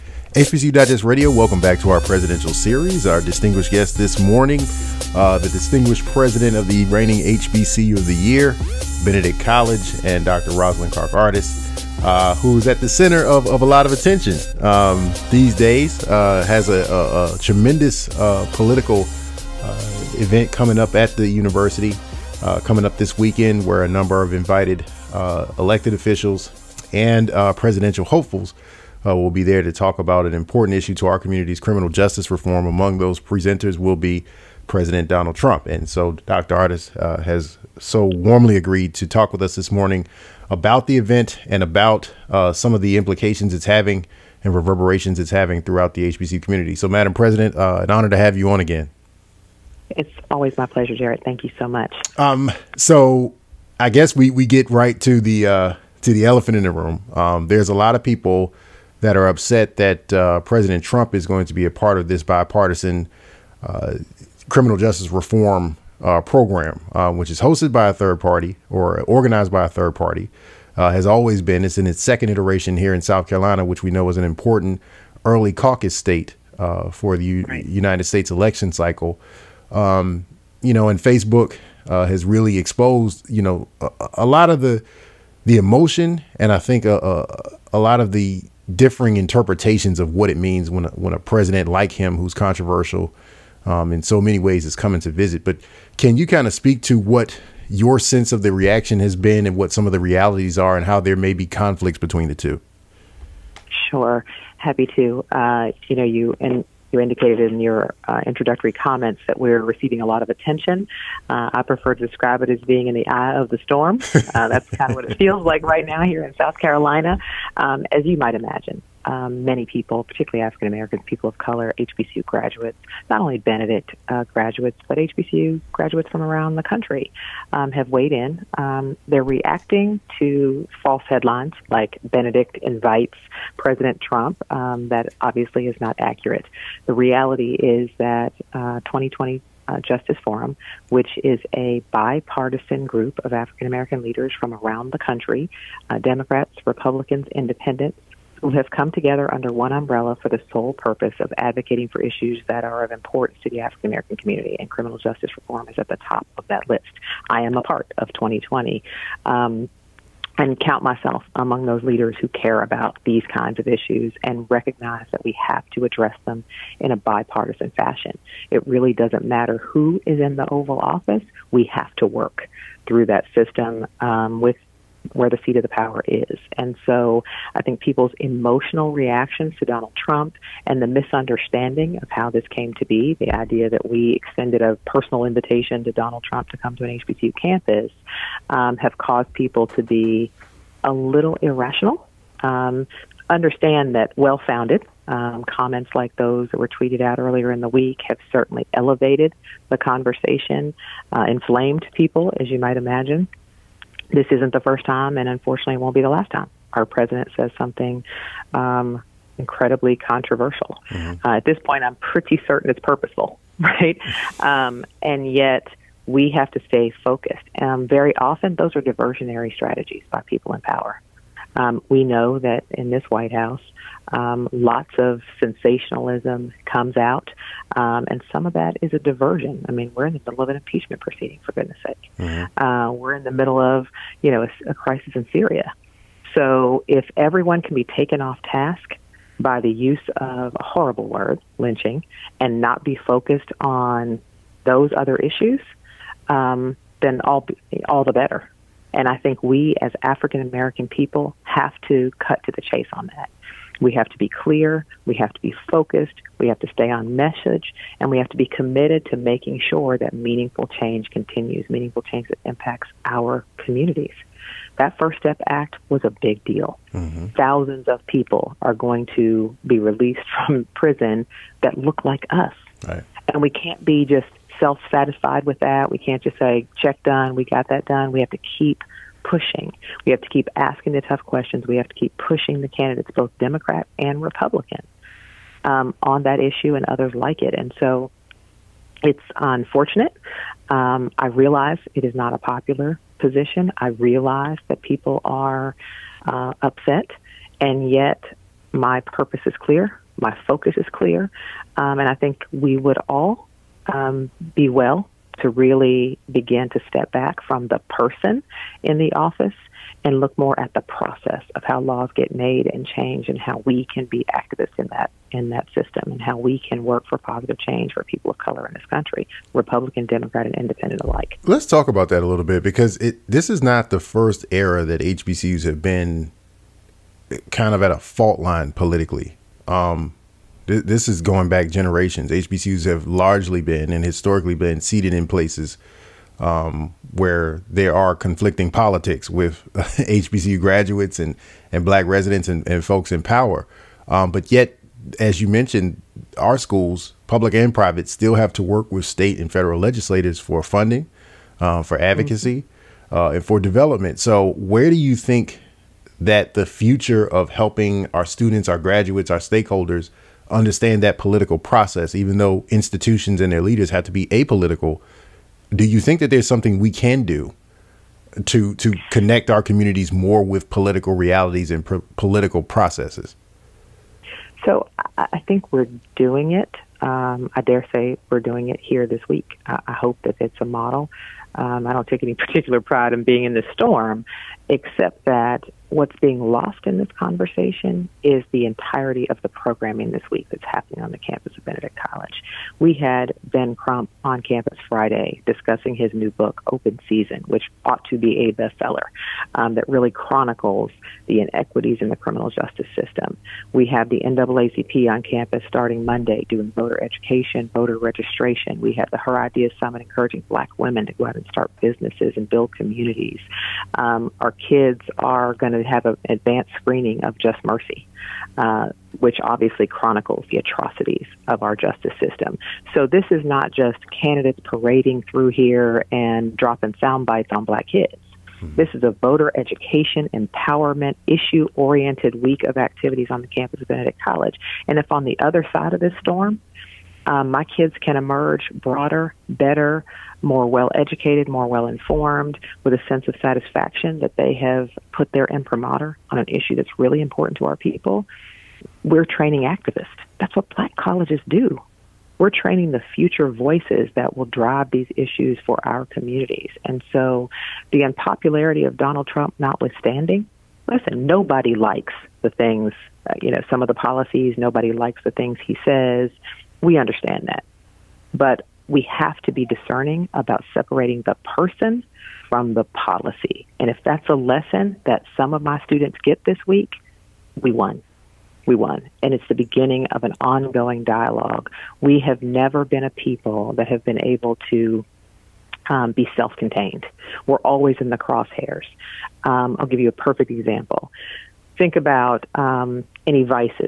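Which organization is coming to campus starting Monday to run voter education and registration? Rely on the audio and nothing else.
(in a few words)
NAACP.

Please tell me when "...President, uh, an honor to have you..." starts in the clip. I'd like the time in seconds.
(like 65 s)
47 s.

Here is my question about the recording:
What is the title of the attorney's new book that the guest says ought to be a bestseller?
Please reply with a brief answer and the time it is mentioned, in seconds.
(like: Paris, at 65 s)
Open Season, at 396 s.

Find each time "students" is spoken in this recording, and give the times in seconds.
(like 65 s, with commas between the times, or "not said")
358 s, 475 s.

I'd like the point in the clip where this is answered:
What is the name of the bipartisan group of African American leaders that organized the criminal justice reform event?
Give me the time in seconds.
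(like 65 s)
138 s.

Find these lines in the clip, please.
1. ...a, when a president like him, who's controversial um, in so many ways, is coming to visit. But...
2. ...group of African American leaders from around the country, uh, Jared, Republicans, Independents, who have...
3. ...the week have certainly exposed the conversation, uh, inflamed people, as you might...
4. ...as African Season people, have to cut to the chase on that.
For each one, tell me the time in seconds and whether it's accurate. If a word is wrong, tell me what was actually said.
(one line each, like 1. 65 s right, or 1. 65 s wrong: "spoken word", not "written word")
1. 90 s right
2. 142 s wrong: "Democrats", not "Jared"
3. 197 s wrong: "elevated", not "exposed"
4. 249 s wrong: "American", not "Season".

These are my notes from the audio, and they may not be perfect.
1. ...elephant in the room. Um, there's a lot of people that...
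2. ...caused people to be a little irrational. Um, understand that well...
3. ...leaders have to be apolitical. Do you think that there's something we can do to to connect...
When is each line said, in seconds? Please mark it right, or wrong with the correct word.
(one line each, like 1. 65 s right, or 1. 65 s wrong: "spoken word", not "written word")
1. 56 s right
2. 188 s right
3. 363 s right.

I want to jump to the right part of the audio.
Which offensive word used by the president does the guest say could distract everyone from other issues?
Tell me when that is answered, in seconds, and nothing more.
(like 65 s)
241 s.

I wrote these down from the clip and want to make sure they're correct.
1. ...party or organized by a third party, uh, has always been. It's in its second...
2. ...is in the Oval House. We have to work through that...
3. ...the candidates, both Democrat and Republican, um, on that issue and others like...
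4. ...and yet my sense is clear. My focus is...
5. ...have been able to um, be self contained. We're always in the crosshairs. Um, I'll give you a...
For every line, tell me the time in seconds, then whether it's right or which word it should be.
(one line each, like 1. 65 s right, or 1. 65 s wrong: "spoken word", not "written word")
1. 68 s right
2. 170 s wrong: "Office", not "House"
3. 282 s right
4. 297 s wrong: "purpose", not "sense"
5. 483 s right.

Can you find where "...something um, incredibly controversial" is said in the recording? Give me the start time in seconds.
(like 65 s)
207 s.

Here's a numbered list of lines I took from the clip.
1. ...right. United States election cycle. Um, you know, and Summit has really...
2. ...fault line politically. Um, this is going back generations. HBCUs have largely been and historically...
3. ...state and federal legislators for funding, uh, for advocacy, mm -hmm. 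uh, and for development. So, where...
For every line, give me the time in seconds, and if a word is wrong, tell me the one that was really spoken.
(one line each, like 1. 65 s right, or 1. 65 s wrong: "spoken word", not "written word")
1. 77 s wrong: "Facebook", not "Summit"
2. 327 s right
3. 349 s right.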